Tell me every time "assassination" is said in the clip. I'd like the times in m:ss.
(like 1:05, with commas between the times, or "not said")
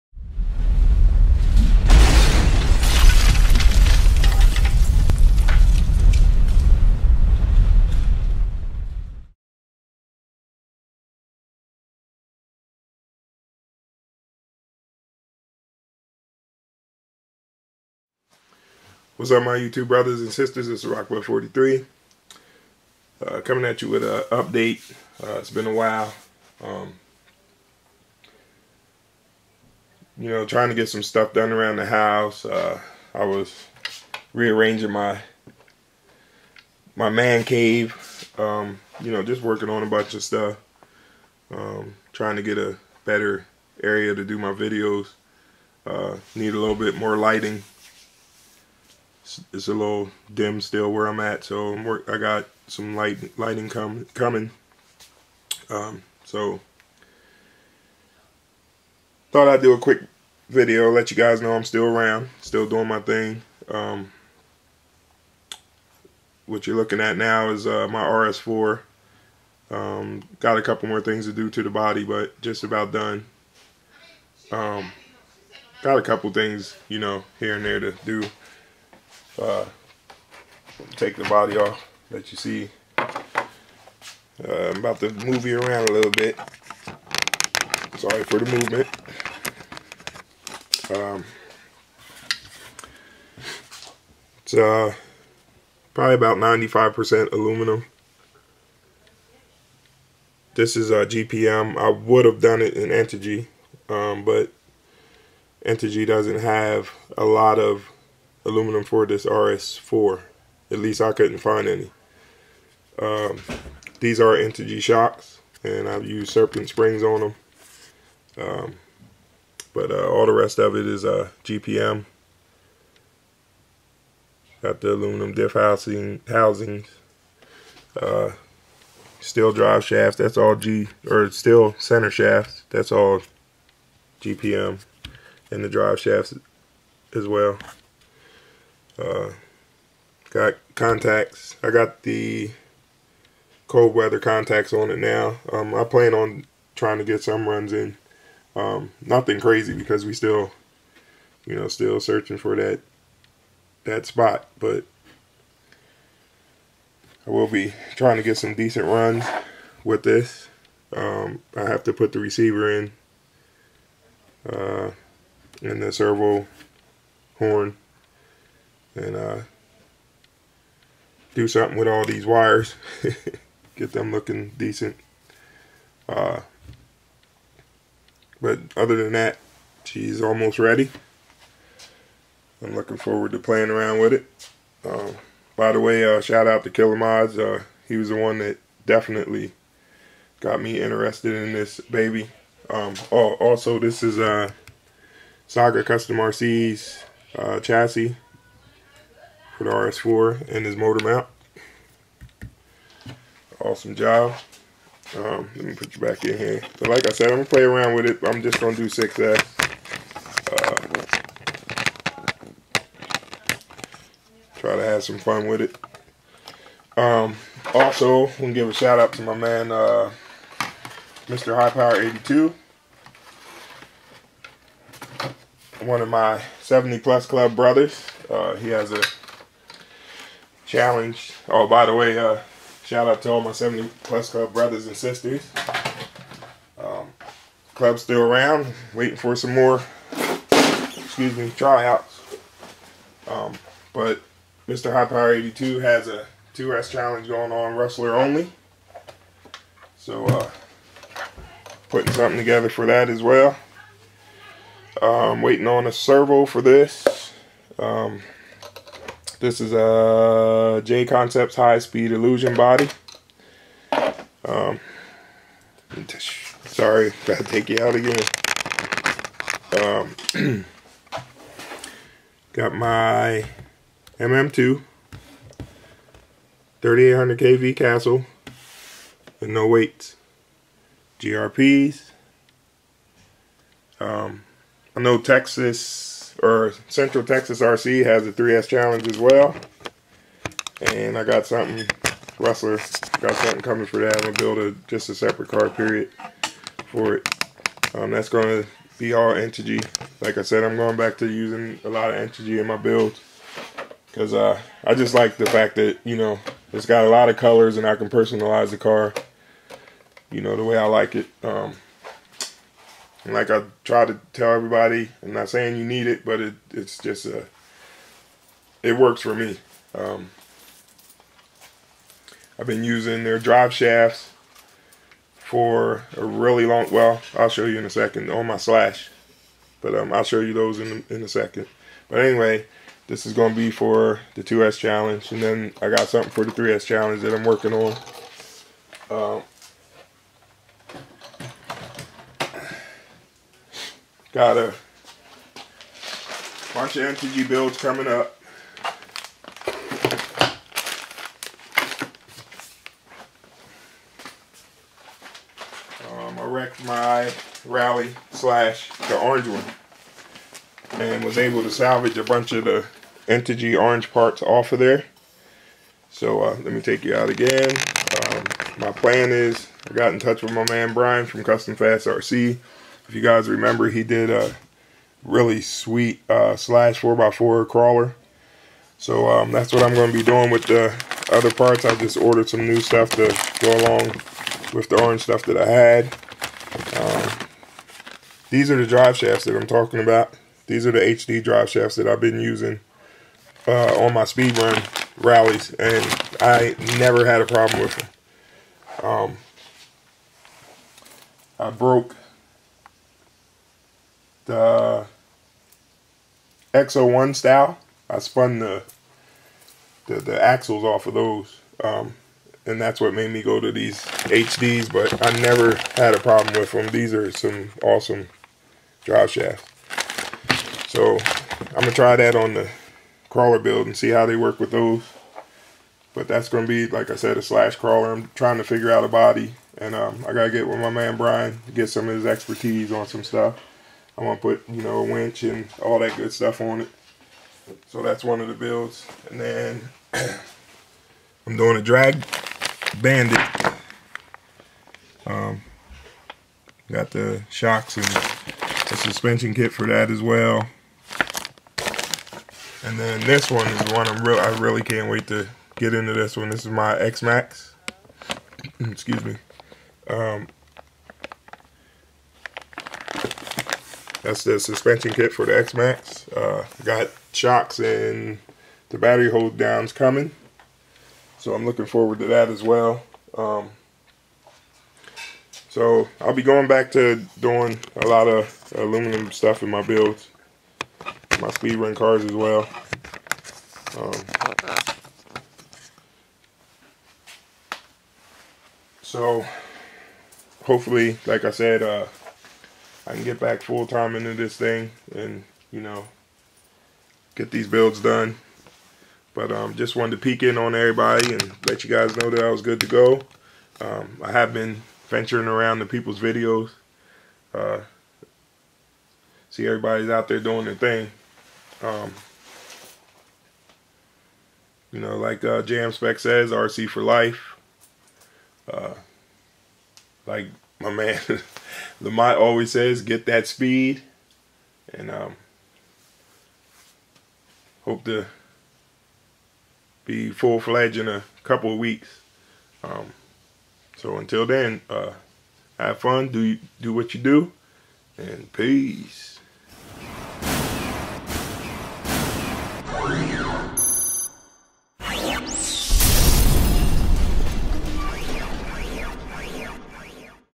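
not said.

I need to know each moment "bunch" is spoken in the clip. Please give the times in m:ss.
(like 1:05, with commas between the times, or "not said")
0:39, 5:46, 6:02.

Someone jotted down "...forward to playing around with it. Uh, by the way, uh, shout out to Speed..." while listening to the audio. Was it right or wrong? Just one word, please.
wrong.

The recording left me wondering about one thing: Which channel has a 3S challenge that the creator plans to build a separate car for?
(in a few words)
Central Texas RC.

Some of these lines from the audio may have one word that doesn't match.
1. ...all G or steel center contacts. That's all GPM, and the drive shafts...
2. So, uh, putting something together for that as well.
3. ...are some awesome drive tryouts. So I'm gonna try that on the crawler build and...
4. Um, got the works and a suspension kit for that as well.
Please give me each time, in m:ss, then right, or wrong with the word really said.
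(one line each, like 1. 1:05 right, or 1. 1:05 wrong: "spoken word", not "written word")
1. 2:10 wrong: "shafts", not "contacts"
2. 4:09 right
3. 6:57 wrong: "shafts", not "tryouts"
4. 7:25 wrong: "shocks", not "works".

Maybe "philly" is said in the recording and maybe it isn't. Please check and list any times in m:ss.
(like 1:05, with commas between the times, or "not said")
not said.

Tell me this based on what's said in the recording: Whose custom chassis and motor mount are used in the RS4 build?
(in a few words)
Saga Custom RC.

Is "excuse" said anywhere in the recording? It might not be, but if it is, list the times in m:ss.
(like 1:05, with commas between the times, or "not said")
4:00, 7:38.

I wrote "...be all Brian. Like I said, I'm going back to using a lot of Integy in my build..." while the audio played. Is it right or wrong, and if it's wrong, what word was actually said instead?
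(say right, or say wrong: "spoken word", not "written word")
wrong: "Integy", not "Brian".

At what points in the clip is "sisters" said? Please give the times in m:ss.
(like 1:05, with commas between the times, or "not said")
0:20, 3:54.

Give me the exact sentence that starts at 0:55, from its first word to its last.
Um, so thought I'd do a quick video, let you guys know I'm still around, still doing my thing.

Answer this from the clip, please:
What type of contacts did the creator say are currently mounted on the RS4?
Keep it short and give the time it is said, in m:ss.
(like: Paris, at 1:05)
Cold weather contacts, at 2:23.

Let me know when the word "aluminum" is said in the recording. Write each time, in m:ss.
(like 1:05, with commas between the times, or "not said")
1:37, 1:48, 2:04, 7:58.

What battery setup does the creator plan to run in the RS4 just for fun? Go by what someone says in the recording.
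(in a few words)
6S.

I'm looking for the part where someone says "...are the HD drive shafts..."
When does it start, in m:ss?
6:30.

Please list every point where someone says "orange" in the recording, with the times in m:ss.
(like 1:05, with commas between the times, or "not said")
5:59, 6:03, 6:25.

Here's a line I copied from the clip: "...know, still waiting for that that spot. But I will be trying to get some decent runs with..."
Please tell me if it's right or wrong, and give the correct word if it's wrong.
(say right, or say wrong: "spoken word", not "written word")
wrong: "searching", not "waiting".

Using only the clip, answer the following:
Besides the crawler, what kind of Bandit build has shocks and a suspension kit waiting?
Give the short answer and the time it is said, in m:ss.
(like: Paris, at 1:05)
Drag Bandit, at 7:21.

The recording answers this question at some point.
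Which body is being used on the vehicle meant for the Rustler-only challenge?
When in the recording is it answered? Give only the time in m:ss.
4:20.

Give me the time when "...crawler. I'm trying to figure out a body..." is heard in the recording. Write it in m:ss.
7:07.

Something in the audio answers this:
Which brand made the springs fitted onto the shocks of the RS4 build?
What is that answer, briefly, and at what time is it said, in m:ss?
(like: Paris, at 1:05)
Serpent, at 1:56.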